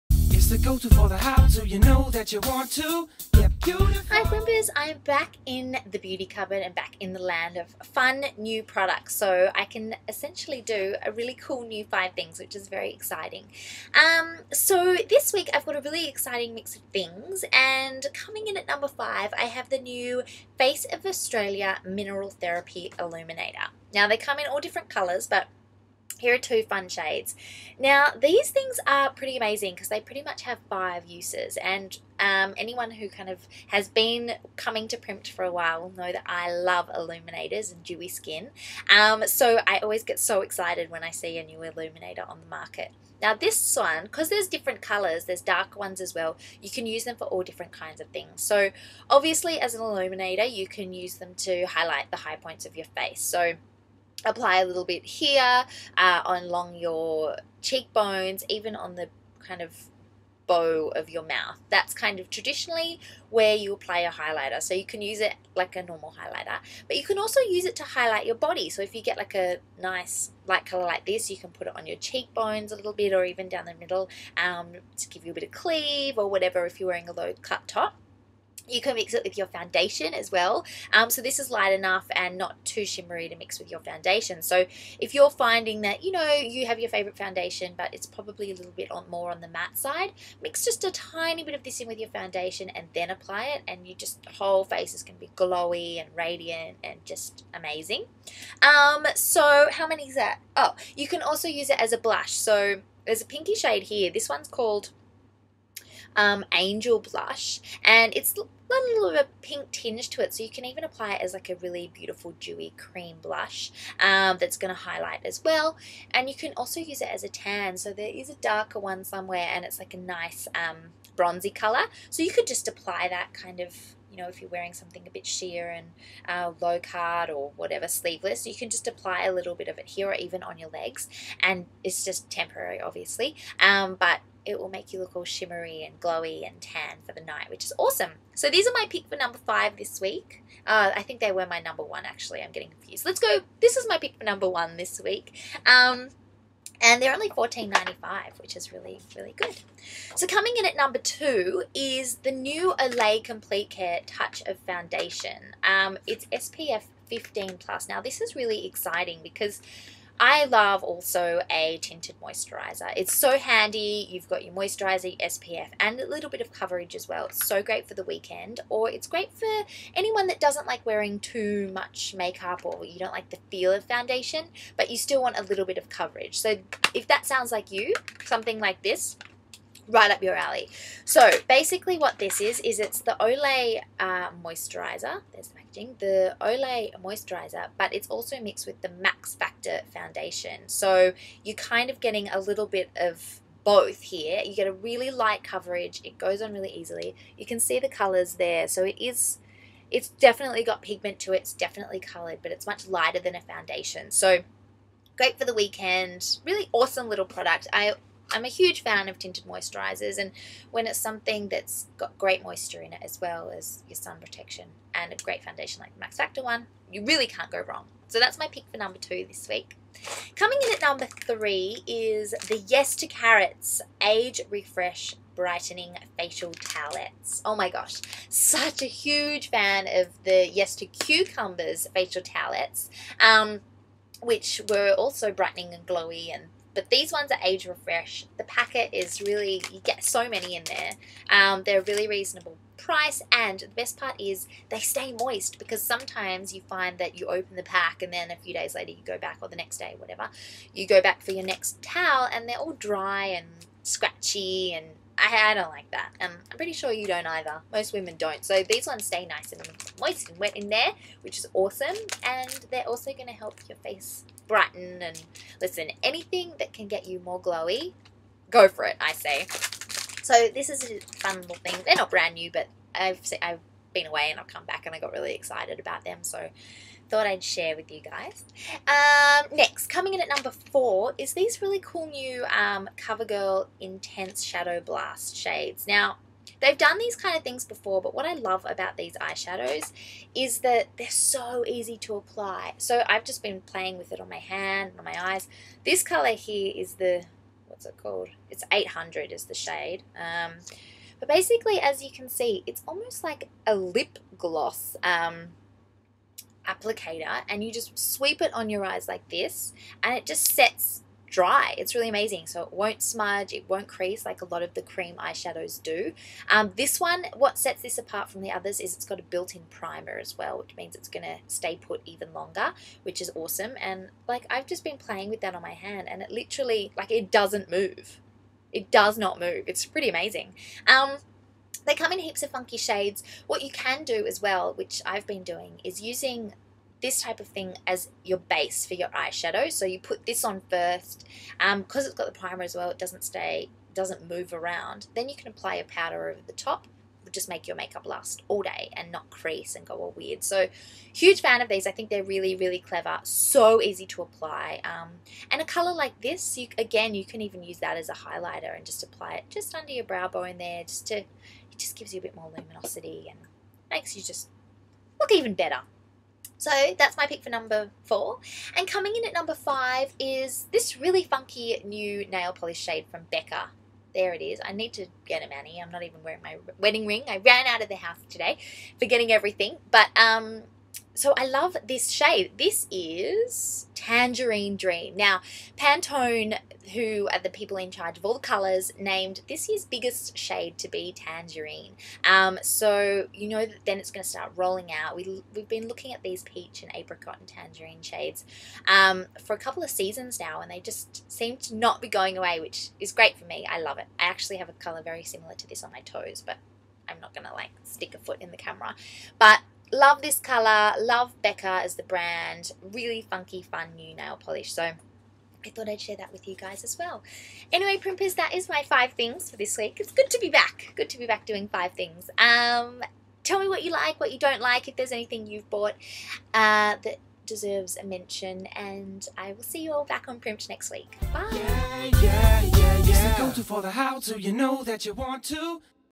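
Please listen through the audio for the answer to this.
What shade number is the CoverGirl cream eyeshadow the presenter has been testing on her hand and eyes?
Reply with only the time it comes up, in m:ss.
4:58.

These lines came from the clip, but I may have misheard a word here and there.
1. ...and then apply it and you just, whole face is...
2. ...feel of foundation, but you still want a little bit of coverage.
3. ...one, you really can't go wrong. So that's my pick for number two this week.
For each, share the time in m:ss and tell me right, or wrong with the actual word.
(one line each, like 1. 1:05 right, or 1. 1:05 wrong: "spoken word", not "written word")
1. 1:32 right
2. 2:53 right
3. 3:36 right.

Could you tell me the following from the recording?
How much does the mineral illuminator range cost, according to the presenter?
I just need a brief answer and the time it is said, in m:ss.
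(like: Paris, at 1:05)
$14.95, at 2:27.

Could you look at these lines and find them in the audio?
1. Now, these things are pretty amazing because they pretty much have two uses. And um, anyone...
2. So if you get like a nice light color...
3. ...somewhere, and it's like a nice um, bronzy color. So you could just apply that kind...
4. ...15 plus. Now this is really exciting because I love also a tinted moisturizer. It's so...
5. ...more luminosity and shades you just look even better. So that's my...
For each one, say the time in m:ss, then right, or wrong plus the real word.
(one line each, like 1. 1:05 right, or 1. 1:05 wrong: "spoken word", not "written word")
1. 0:27 wrong: "five", not "two"
2. 1:08 right
3. 1:59 right
4. 2:37 right
5. 6:02 wrong: "makes", not "shades".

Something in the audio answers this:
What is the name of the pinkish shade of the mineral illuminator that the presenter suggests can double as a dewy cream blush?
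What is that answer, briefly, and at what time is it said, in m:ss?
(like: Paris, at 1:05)
Angel Blush, at 1:46.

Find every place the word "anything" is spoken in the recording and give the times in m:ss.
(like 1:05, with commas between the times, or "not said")
4:26, 7:05.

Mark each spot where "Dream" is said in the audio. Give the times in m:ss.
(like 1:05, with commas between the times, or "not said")
6:24.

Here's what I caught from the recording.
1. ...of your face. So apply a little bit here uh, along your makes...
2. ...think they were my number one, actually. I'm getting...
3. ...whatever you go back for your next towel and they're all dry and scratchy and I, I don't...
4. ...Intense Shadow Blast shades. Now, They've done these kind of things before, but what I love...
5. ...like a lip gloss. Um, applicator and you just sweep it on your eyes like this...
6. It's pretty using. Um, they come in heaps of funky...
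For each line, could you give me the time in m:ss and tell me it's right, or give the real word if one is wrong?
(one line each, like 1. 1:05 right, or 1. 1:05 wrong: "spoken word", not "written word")
1. 0:52 wrong: "cheekbones", not "makes"
2. 2:21 right
3. 4:09 right
4. 4:43 right
5. 5:03 right
6. 5:29 wrong: "amazing", not "using".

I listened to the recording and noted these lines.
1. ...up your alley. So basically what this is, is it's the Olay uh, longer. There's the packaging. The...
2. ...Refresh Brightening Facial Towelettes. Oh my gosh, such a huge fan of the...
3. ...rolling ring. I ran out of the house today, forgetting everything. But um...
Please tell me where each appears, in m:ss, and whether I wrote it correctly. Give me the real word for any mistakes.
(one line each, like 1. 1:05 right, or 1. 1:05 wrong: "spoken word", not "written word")
1. 3:00 wrong: "moisturizer", not "longer"
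2. 3:44 right
3. 6:16 wrong: "wedding", not "rolling".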